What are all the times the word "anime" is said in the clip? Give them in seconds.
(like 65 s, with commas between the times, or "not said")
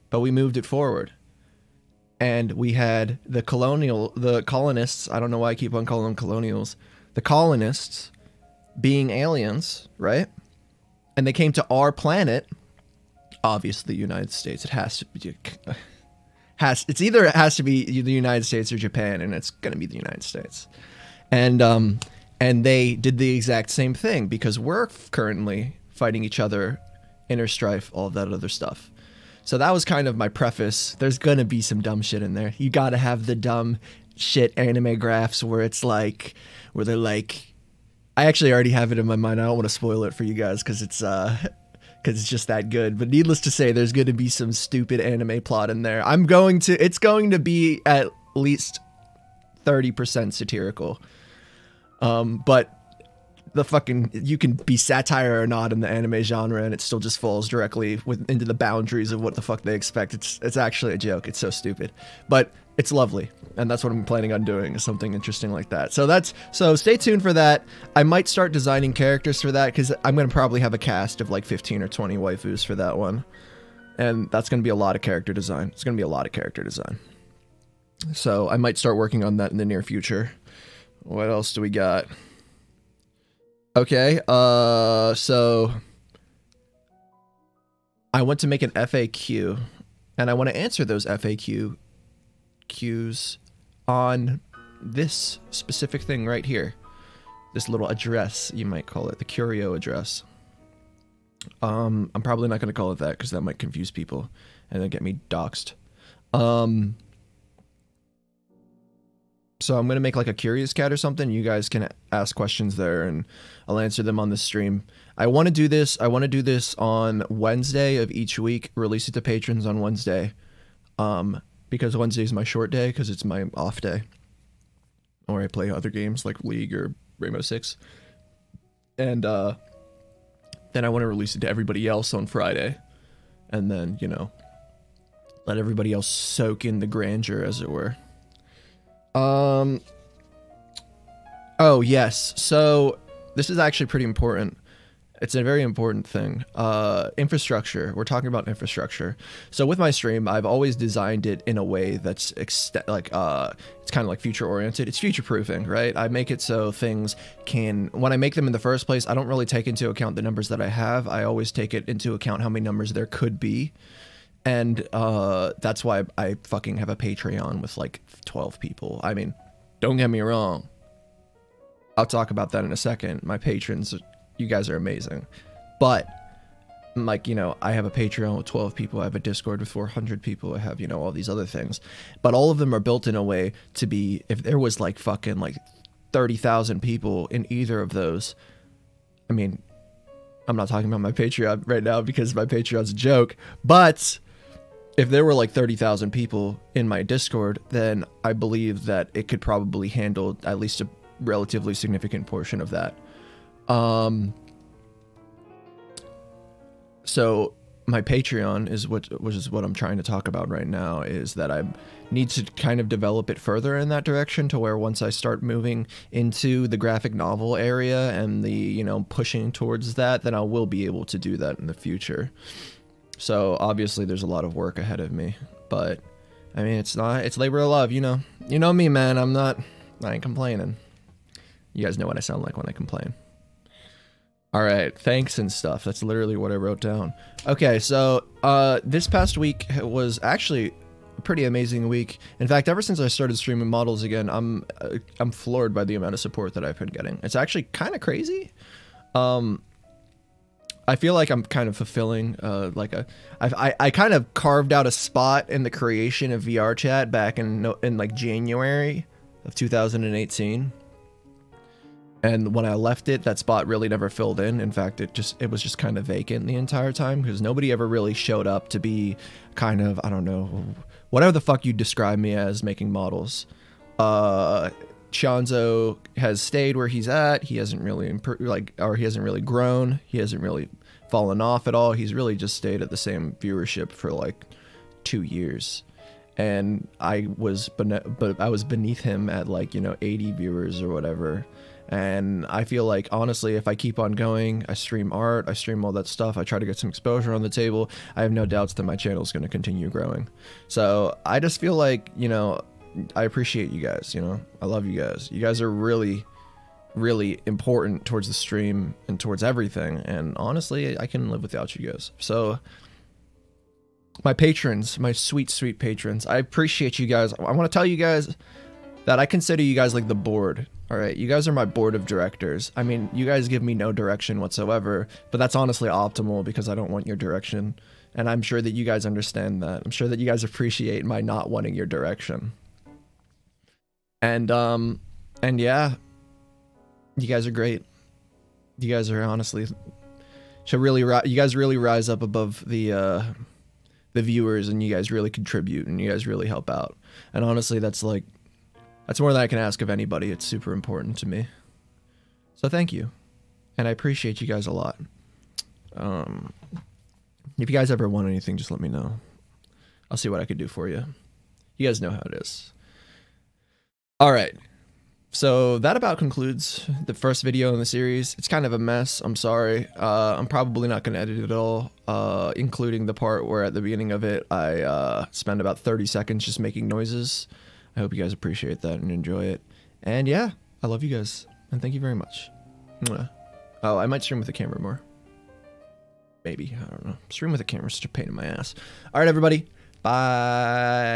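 34 s, 45 s, 55 s.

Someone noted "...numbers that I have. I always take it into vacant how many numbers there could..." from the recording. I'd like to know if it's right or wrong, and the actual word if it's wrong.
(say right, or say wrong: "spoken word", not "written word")
wrong: "account", not "vacant".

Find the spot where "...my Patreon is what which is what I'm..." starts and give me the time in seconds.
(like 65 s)
207 s.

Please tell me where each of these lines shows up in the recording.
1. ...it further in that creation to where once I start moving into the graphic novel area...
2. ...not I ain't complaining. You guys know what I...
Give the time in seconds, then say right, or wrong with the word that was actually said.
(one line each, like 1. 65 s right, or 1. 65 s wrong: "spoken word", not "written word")
1. 213 s wrong: "direction", not "creation"
2. 229 s right.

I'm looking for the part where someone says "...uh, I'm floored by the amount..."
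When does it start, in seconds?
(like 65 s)
244 s.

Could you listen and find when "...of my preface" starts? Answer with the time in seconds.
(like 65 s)
30 s.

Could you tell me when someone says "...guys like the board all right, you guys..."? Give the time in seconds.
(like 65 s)
319 s.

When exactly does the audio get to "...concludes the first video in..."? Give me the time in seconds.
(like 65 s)
366 s.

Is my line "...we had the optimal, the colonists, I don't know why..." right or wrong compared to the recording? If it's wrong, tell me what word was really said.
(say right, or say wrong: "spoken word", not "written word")
wrong: "colonial", not "optimal".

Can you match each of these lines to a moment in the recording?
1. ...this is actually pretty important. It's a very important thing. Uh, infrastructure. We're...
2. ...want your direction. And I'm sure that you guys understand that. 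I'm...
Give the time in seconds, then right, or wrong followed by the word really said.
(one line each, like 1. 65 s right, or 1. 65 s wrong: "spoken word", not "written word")
1. 143 s right
2. 326 s right.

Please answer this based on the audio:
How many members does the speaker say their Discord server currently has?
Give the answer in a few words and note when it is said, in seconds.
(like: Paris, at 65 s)
400, at 179 s.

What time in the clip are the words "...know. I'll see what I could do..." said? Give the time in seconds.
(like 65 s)
358 s.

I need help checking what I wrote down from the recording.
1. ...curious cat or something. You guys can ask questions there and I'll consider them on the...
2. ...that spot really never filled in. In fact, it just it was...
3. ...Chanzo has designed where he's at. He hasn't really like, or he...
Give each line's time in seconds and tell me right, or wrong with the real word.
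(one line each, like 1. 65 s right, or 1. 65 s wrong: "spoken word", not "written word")
1. 110 s wrong: "answer", not "consider"
2. 263 s right
3. 275 s wrong: "stayed", not "designed".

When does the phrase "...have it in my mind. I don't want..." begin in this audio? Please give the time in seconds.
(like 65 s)
38 s.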